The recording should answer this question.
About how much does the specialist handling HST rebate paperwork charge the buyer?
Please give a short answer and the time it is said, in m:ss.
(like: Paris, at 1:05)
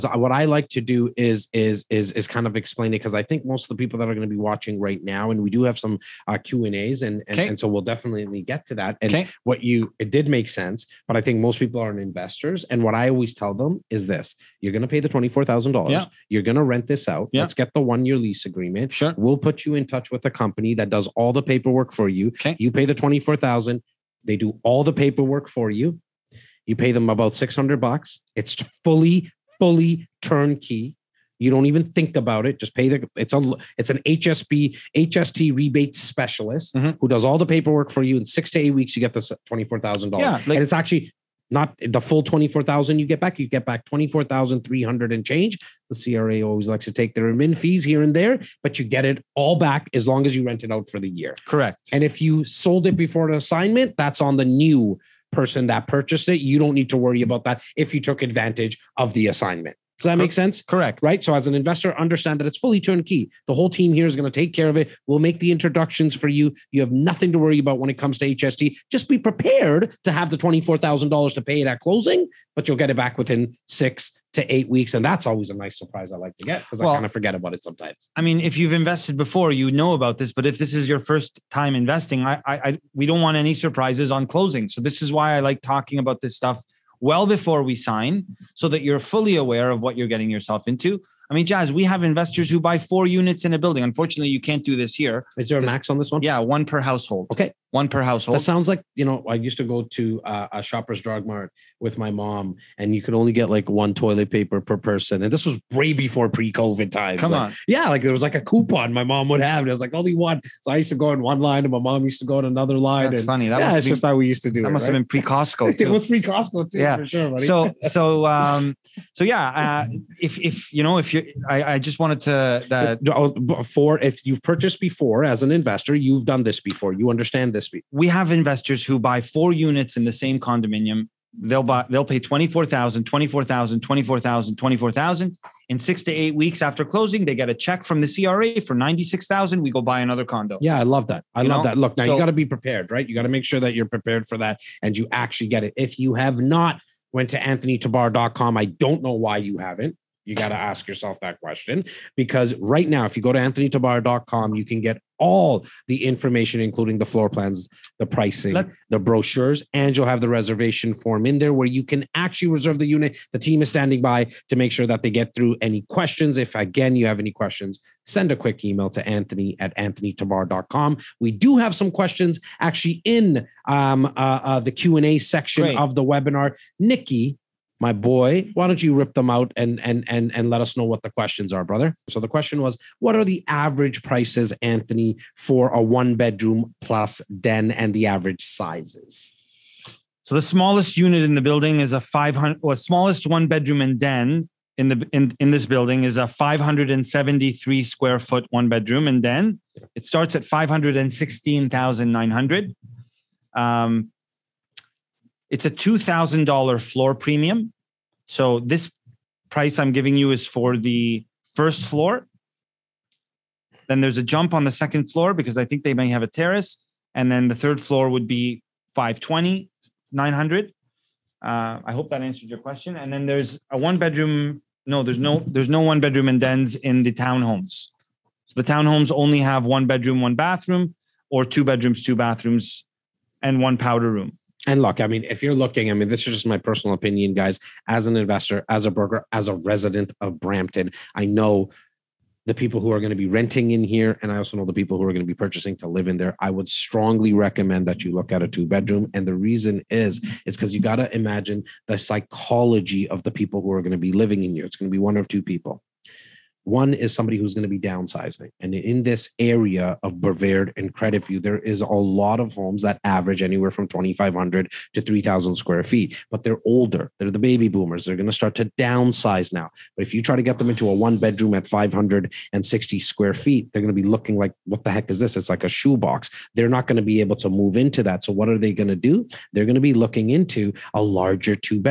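600 bucks, at 0:27.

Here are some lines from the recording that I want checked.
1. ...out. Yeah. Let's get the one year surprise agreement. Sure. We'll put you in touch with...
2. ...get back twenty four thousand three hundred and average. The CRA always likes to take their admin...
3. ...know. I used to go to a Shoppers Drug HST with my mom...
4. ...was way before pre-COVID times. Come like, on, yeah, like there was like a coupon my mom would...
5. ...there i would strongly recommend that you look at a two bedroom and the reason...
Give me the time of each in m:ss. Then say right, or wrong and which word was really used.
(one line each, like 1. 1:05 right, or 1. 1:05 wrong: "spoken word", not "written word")
1. 0:17 wrong: "lease", not "surprise"
2. 0:43 wrong: "change", not "average"
3. 1:39 wrong: "Mart", not "HST"
4. 1:45 right
5. 4:06 right.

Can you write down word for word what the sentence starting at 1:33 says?
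Unfortunately, you can't do this here.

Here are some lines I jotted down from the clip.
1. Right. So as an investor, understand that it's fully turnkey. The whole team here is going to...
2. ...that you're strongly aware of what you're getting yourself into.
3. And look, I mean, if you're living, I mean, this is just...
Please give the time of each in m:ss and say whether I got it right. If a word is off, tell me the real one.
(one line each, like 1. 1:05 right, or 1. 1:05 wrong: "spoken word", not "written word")
1. 1:01 right
2. 1:28 wrong: "fully", not "strongly"
3. 3:54 wrong: "looking", not "living".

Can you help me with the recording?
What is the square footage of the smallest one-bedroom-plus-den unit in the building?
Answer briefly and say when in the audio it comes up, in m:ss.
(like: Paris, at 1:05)
573 square feet, at 3:16.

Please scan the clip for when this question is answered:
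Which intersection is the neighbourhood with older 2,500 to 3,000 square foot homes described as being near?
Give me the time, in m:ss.
4:20.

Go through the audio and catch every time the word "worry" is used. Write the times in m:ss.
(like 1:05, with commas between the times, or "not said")
0:56, 1:07.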